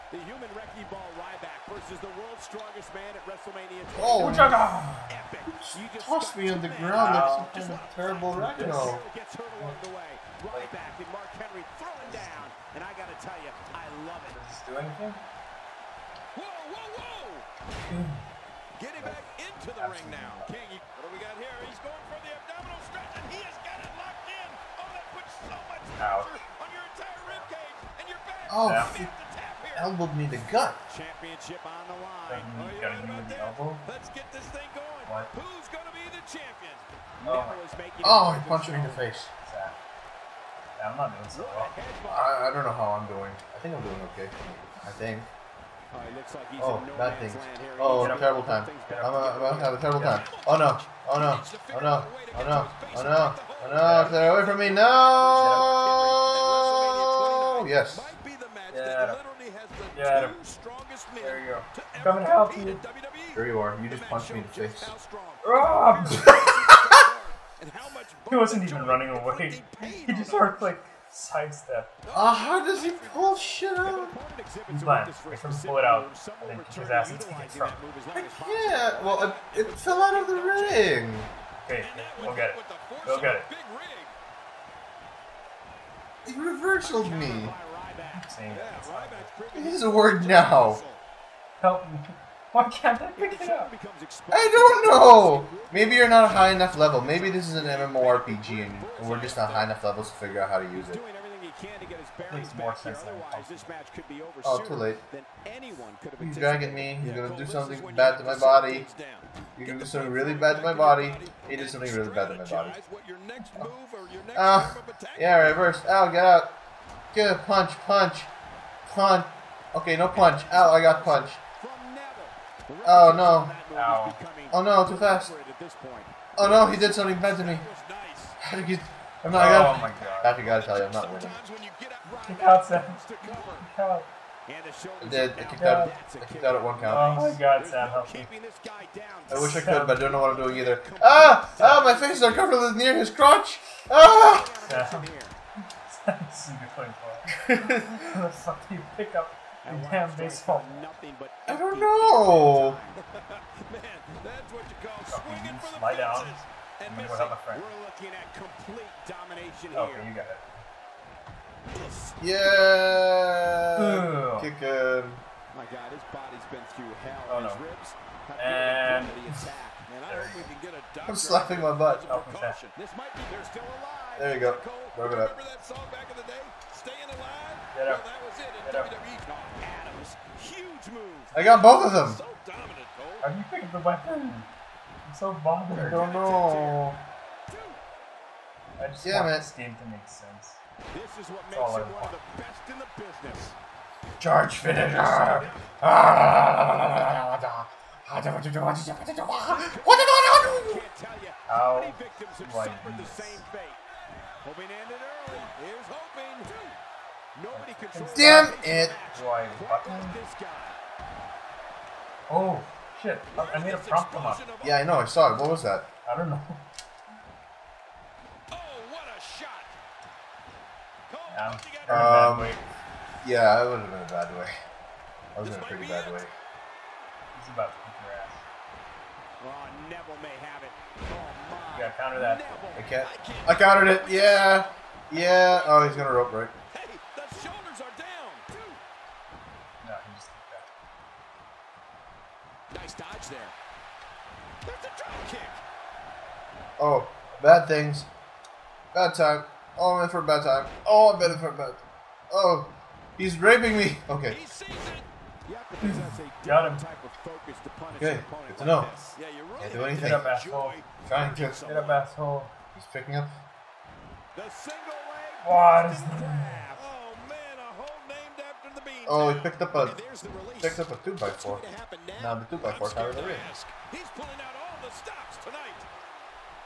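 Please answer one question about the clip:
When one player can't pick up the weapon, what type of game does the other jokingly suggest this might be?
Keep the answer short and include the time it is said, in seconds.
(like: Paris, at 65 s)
MMORPG, at 97 s.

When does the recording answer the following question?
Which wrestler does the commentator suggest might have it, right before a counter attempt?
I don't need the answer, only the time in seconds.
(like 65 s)
229 s.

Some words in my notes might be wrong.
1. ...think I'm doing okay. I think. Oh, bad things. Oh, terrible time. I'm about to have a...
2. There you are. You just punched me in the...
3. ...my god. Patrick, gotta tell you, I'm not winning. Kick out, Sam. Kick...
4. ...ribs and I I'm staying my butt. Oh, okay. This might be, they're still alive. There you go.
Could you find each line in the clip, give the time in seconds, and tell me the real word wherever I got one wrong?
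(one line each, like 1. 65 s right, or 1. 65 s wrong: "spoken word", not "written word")
1. 43 s right
2. 63 s right
3. 129 s right
4. 167 s wrong: "slapping", not "staying".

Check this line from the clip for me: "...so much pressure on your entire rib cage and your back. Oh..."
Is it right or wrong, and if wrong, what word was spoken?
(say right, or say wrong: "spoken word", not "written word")
right.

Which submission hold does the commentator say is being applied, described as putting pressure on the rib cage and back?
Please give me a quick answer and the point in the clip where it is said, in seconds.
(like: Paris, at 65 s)
abdominal stretch, at 22 s.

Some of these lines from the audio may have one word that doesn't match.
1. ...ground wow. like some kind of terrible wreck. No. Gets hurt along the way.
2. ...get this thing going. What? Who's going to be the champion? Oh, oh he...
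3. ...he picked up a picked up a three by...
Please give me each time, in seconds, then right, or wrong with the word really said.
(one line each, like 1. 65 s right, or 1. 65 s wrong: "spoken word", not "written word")
1. 6 s right
2. 34 s right
3. 269 s wrong: "two", not "three".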